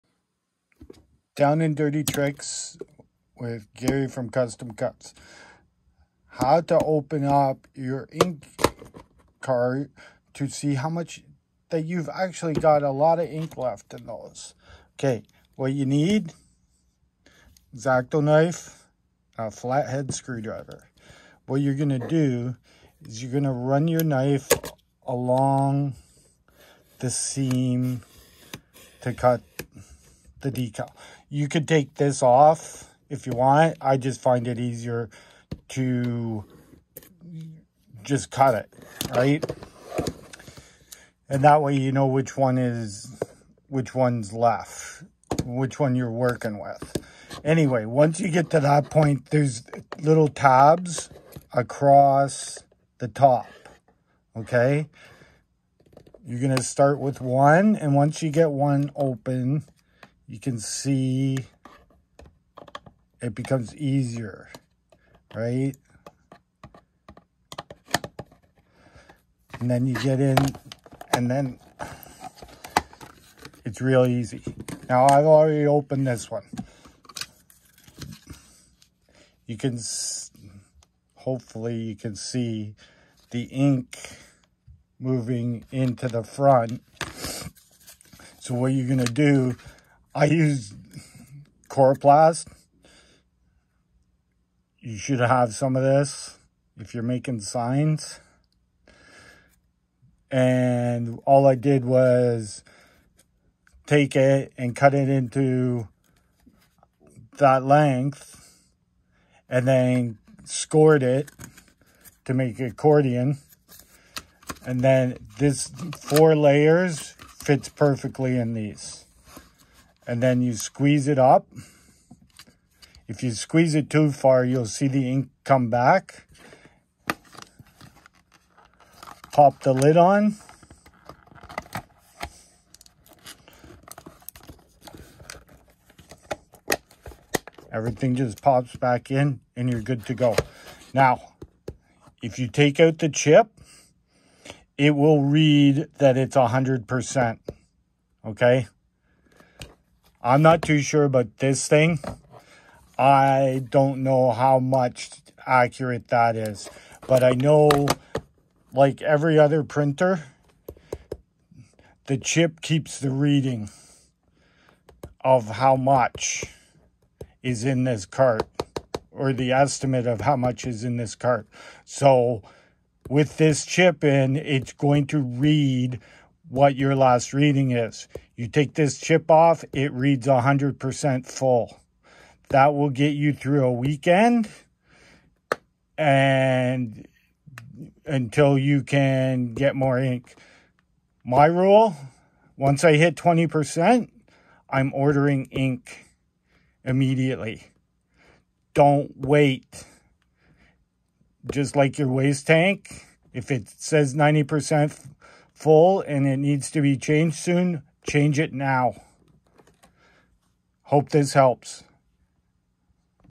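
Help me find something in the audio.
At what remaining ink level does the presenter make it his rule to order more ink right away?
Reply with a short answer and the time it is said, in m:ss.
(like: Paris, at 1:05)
20%, at 3:13.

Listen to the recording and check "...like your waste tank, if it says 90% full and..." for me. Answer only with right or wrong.
right.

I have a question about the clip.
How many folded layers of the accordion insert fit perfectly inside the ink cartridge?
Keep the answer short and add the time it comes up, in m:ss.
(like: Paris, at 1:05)
4, at 1:56.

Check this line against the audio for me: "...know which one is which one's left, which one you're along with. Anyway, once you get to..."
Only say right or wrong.
wrong.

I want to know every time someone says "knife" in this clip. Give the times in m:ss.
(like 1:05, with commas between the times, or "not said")
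0:18, 0:24.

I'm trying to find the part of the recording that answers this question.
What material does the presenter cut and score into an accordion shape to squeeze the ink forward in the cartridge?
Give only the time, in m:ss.
1:31.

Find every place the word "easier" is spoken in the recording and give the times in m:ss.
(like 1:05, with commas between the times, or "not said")
0:34, 1:03.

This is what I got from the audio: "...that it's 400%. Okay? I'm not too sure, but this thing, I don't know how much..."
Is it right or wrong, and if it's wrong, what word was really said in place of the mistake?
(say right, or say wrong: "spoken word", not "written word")
wrong: "100", not "400".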